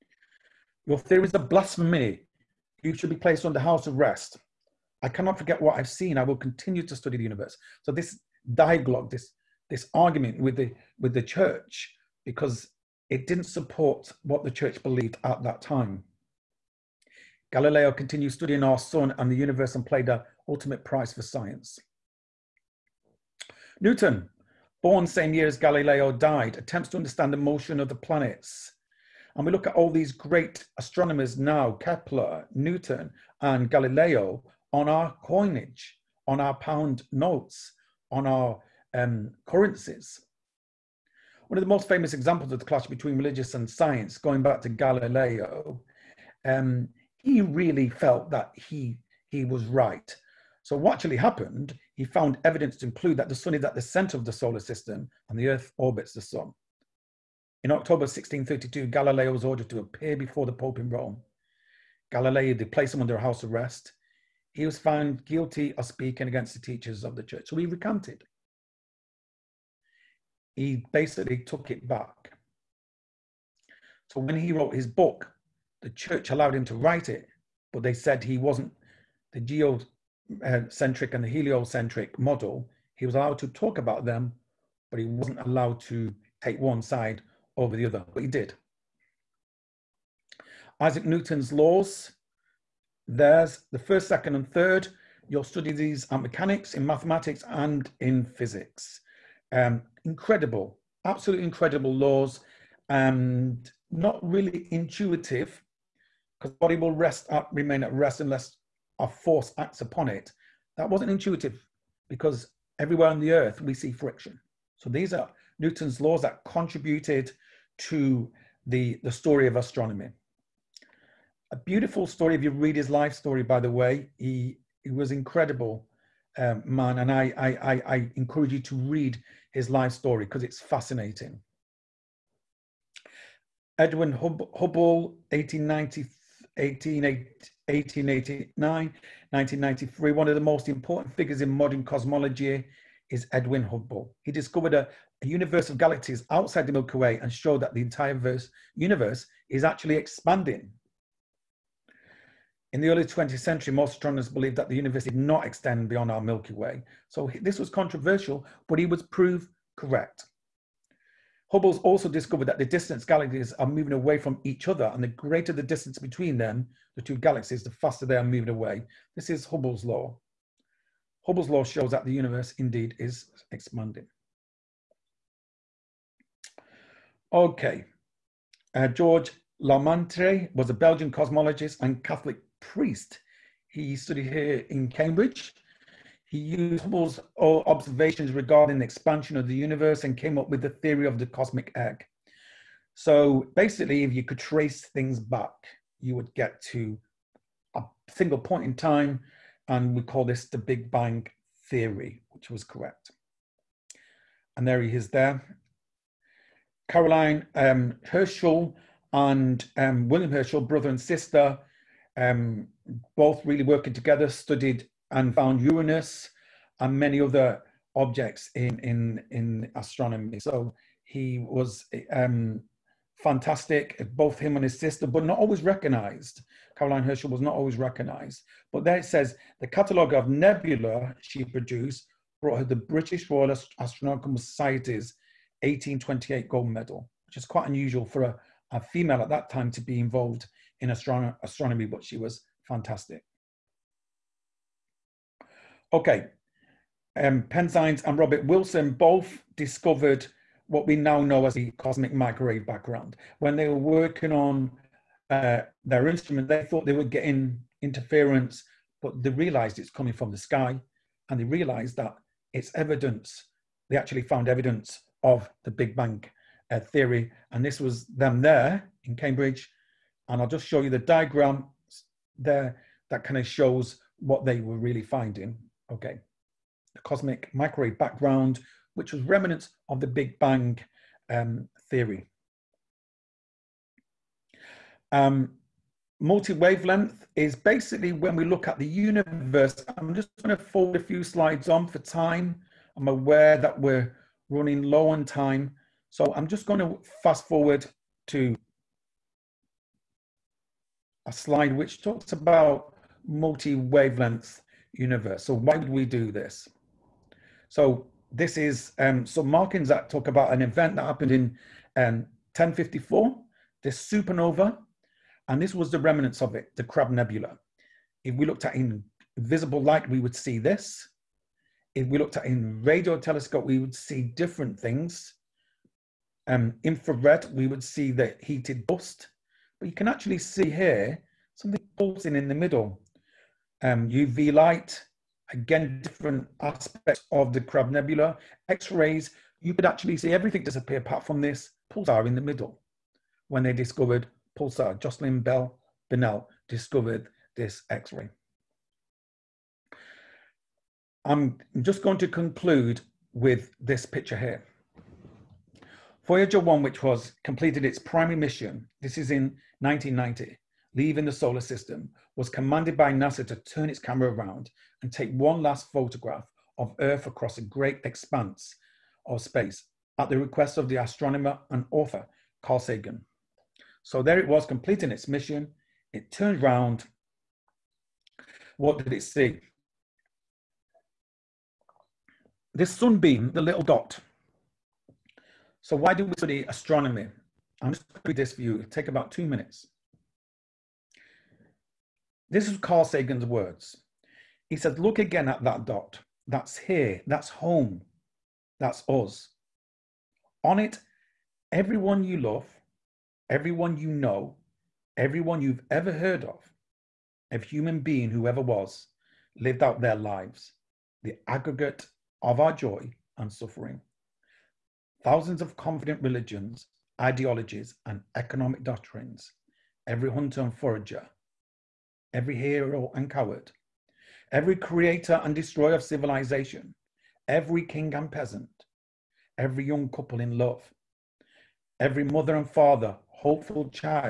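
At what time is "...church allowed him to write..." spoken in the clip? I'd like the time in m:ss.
1:15.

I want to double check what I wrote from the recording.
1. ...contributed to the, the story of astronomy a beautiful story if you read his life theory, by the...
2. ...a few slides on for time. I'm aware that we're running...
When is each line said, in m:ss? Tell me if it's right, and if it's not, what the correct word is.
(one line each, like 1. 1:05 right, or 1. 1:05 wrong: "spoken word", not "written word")
1. 1:56 wrong: "story", not "theory"
2. 4:50 right.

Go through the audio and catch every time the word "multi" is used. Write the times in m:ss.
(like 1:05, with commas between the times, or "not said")
4:46, 5:03.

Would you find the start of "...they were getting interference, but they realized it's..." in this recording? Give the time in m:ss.
4:16.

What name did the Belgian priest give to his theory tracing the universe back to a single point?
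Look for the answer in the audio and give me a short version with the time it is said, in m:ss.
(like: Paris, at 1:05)
the cosmic egg, at 3:11.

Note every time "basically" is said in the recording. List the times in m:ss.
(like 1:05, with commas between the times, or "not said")
1:10, 3:13, 4:47.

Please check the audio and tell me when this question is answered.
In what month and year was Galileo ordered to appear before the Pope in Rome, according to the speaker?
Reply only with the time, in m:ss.
0:57.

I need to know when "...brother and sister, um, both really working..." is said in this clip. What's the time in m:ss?
3:30.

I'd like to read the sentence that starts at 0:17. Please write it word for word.
Galileo continued studying our sun and the universe and played the ultimate prize for science.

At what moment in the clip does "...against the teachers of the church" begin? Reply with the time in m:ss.
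1:06.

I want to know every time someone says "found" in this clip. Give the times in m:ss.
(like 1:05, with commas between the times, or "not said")
0:52, 1:04, 3:35, 4:24.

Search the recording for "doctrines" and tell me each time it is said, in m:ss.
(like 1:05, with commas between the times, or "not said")
6:58.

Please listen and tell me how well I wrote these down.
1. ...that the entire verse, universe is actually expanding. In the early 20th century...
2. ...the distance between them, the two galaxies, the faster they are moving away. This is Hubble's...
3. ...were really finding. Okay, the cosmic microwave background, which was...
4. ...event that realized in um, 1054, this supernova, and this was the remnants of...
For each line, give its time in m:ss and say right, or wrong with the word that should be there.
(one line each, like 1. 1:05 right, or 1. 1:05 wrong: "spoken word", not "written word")
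1. 2:27 right
2. 2:45 right
3. 4:34 right
4. 5:10 wrong: "happened", not "realized".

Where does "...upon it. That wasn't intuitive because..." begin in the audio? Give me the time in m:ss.
1:49.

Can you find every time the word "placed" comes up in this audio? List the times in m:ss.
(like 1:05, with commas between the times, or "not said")
0:03, 1:02.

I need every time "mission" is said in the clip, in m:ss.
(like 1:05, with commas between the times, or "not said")
5:58, 6:15.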